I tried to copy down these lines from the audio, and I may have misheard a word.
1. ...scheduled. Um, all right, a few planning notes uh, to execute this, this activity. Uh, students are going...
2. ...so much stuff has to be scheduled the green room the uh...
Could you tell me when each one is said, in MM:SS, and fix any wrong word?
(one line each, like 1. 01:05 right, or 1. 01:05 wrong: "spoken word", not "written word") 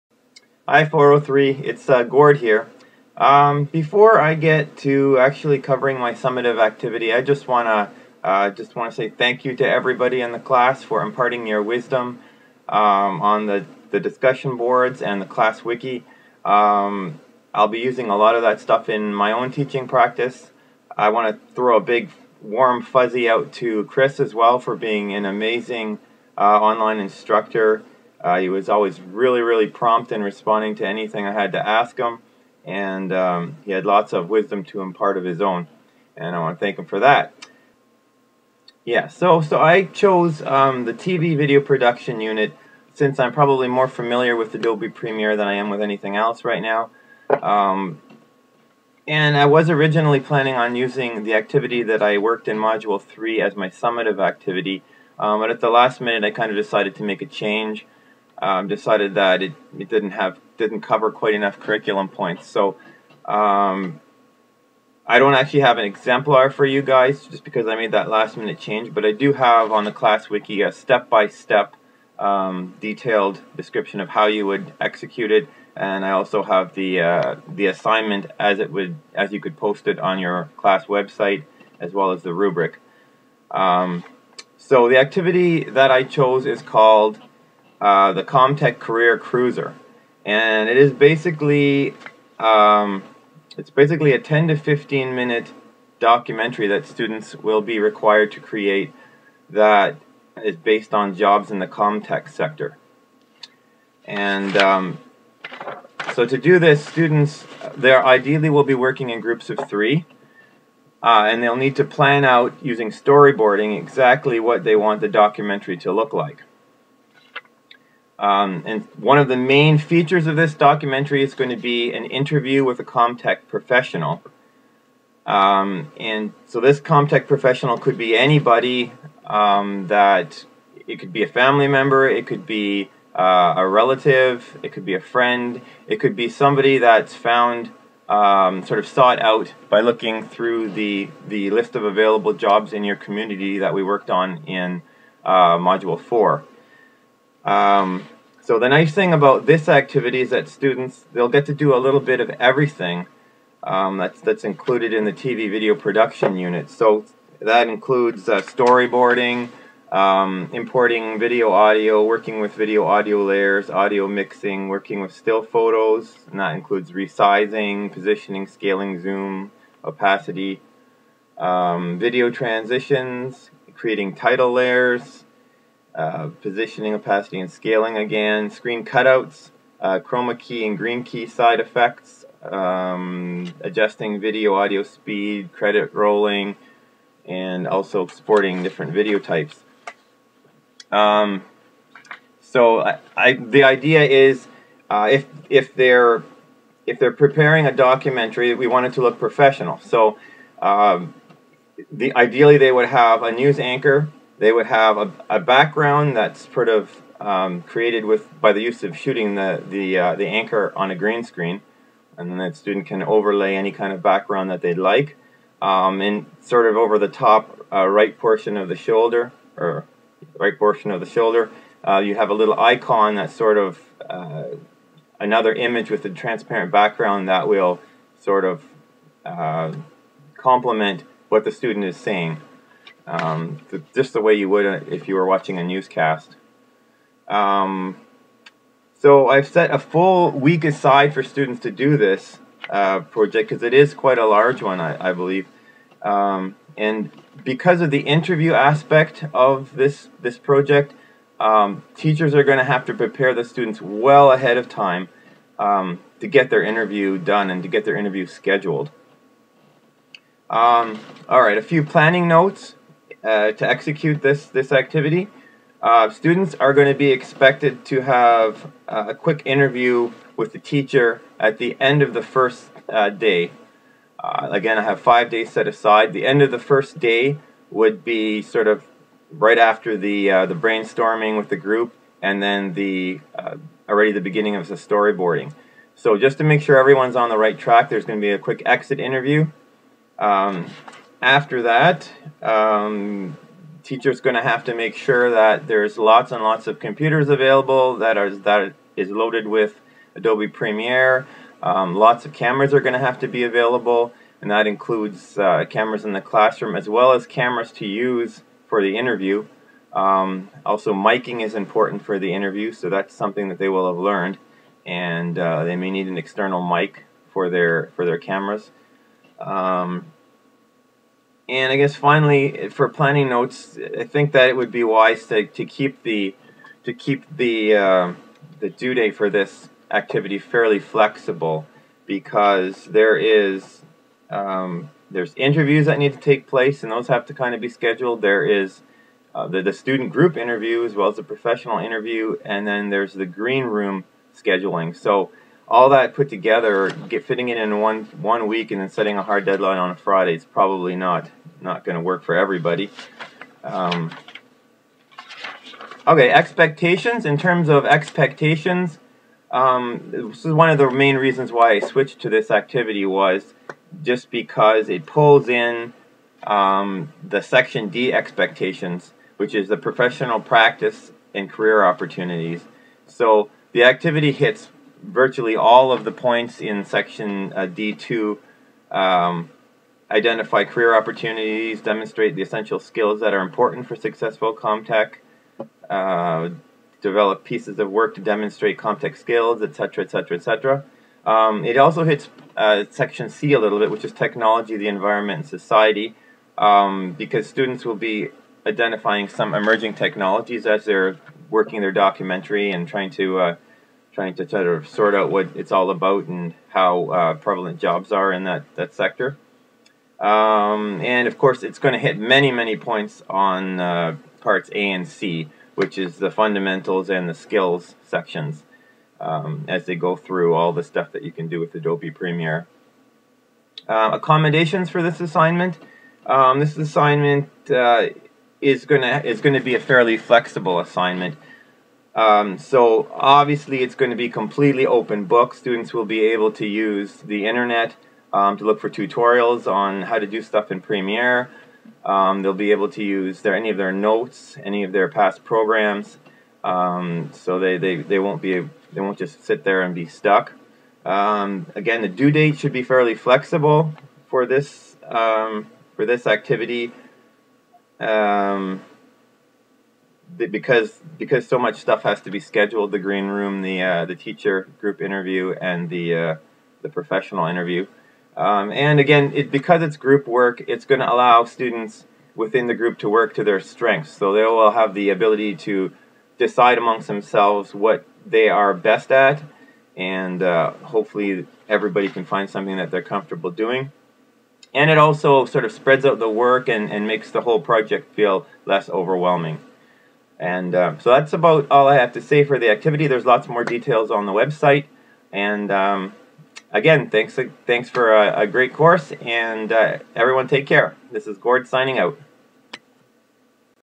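1. 04:18 right
2. 07:41 right.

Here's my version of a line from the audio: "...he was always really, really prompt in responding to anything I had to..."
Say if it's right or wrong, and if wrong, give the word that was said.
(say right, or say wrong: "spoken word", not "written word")
right.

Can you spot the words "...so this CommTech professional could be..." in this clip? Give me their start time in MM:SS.
02:06.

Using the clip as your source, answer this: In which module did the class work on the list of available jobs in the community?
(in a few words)
Module 4.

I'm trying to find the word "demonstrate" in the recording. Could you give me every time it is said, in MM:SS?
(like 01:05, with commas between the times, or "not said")
06:21, 06:28.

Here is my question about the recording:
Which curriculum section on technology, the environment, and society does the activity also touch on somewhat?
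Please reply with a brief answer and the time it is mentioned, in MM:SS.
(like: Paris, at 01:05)
Section C, at 06:32.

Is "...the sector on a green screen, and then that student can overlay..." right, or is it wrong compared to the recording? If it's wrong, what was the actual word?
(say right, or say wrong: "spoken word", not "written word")
wrong: "anchor", not "sector".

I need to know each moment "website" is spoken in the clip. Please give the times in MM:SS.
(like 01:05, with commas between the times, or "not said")
01:20, 08:14.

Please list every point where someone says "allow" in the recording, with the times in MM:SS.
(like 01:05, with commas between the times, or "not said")
07:51.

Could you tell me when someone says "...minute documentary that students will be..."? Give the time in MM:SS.
01:35.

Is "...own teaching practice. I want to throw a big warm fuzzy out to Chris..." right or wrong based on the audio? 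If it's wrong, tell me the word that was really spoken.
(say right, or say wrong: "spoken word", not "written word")
right.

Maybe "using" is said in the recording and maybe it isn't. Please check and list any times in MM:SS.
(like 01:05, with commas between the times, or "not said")
00:17, 00:50, 01:52.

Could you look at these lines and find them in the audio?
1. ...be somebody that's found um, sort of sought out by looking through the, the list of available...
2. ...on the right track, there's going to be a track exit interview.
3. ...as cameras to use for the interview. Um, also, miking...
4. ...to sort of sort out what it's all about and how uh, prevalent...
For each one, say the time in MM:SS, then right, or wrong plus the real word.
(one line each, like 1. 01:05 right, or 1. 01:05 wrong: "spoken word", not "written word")
1. 02:16 right
2. 04:47 wrong: "quick", not "track"
3. 05:07 right
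4. 06:44 right.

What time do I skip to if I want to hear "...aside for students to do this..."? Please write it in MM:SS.
04:00.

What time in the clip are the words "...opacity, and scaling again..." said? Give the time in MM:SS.
02:56.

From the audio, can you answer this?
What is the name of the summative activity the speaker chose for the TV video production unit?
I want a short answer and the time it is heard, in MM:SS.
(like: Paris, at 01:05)
CommTech Career Cruiser, at 01:28.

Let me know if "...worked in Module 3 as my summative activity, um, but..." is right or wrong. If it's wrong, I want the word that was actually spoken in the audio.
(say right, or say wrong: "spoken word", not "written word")
right.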